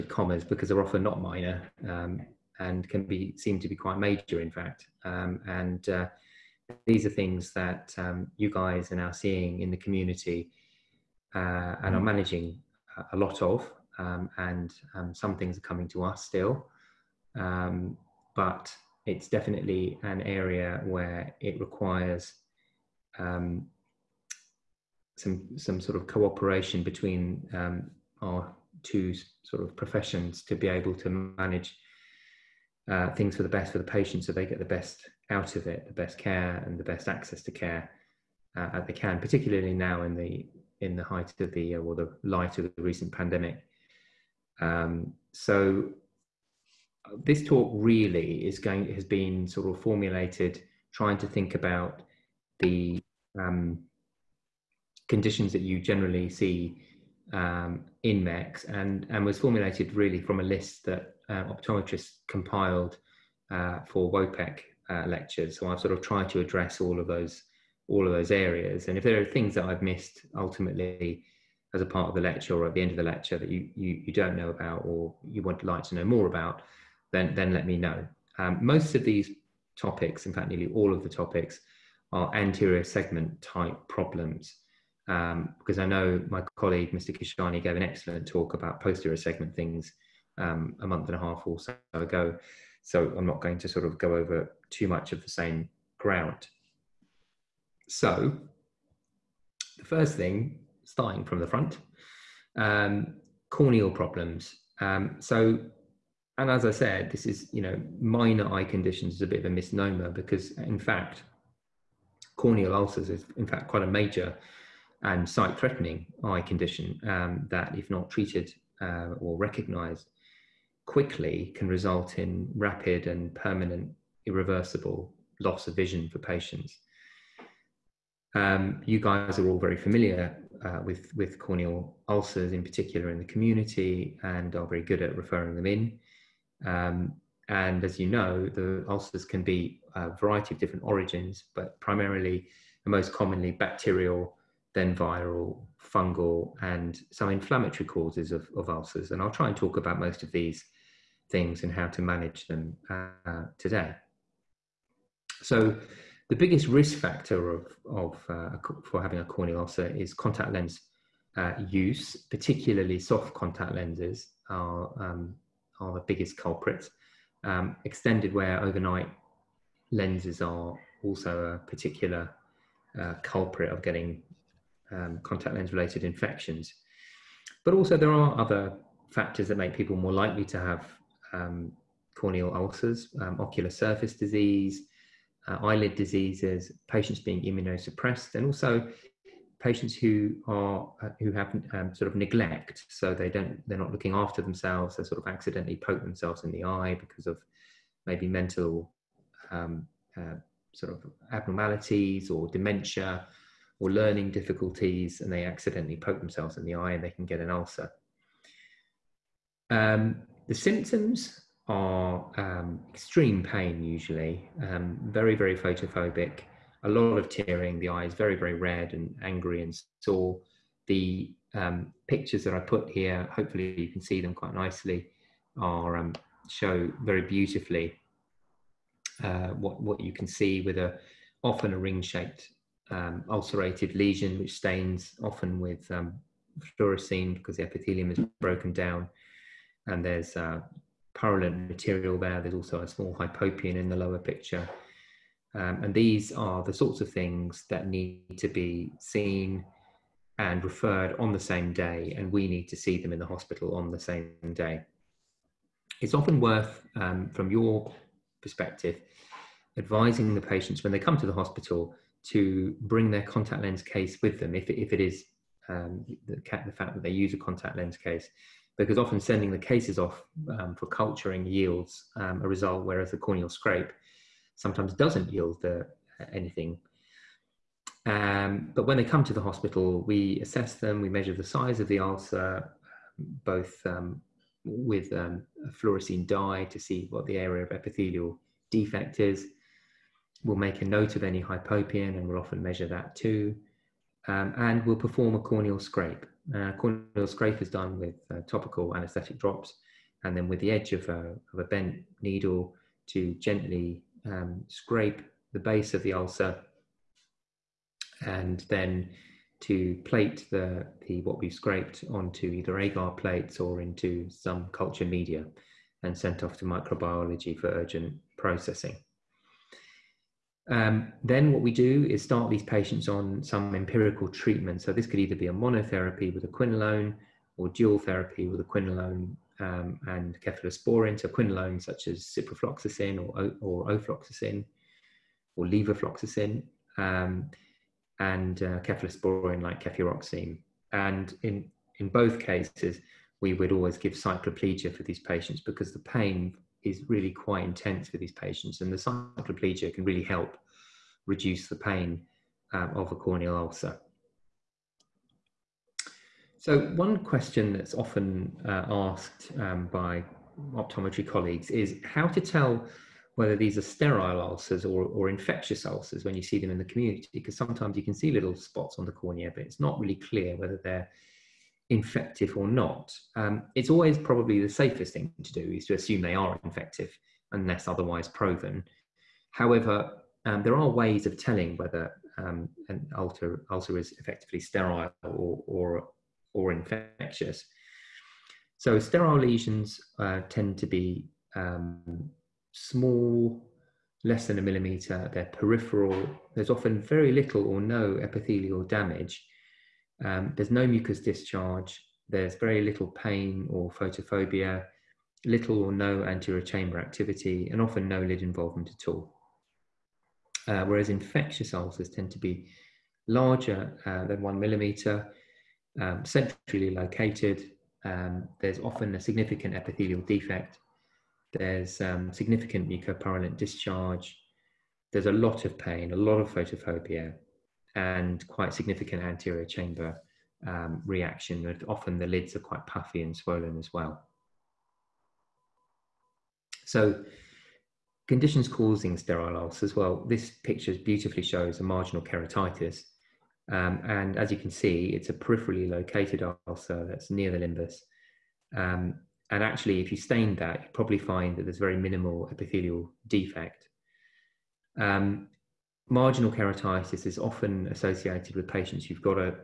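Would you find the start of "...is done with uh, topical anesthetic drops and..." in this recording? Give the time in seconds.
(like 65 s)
297 s.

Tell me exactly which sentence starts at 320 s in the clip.
Um, then what we do is start these patients on some empirical treatment.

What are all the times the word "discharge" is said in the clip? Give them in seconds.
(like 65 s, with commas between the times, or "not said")
401 s, 423 s.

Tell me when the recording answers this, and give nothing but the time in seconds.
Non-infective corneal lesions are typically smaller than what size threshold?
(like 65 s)
394 s.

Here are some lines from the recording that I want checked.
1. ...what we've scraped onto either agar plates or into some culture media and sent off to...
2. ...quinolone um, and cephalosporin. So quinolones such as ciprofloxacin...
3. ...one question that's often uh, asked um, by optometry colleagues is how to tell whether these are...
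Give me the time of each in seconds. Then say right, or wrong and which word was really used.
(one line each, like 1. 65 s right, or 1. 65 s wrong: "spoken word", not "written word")
1. 311 s right
2. 328 s right
3. 356 s right.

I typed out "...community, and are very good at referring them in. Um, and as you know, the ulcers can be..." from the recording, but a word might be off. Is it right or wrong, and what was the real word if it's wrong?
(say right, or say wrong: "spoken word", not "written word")
right.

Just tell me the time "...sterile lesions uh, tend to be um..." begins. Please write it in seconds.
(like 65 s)
388 s.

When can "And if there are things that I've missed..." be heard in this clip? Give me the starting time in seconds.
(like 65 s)
68 s.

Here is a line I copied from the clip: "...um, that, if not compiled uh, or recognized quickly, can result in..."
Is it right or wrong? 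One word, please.
wrong.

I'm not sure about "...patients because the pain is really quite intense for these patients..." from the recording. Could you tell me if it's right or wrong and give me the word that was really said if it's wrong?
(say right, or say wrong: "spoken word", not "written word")
right.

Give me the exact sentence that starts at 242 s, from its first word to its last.
There's also a small hypopyon in the lower picture.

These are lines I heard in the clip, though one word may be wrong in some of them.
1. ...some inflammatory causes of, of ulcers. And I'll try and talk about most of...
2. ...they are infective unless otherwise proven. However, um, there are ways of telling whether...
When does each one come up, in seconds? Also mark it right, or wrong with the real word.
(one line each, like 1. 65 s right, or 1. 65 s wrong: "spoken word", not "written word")
1. 147 s right
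2. 376 s right.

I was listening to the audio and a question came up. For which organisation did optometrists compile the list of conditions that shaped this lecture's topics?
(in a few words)
WOPEC.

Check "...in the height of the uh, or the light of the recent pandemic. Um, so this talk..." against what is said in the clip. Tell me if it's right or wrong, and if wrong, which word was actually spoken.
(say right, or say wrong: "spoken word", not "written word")
right.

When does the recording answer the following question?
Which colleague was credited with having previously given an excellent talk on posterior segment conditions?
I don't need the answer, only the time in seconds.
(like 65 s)
86 s.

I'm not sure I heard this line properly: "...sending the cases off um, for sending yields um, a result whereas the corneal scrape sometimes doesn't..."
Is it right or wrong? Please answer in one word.
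wrong.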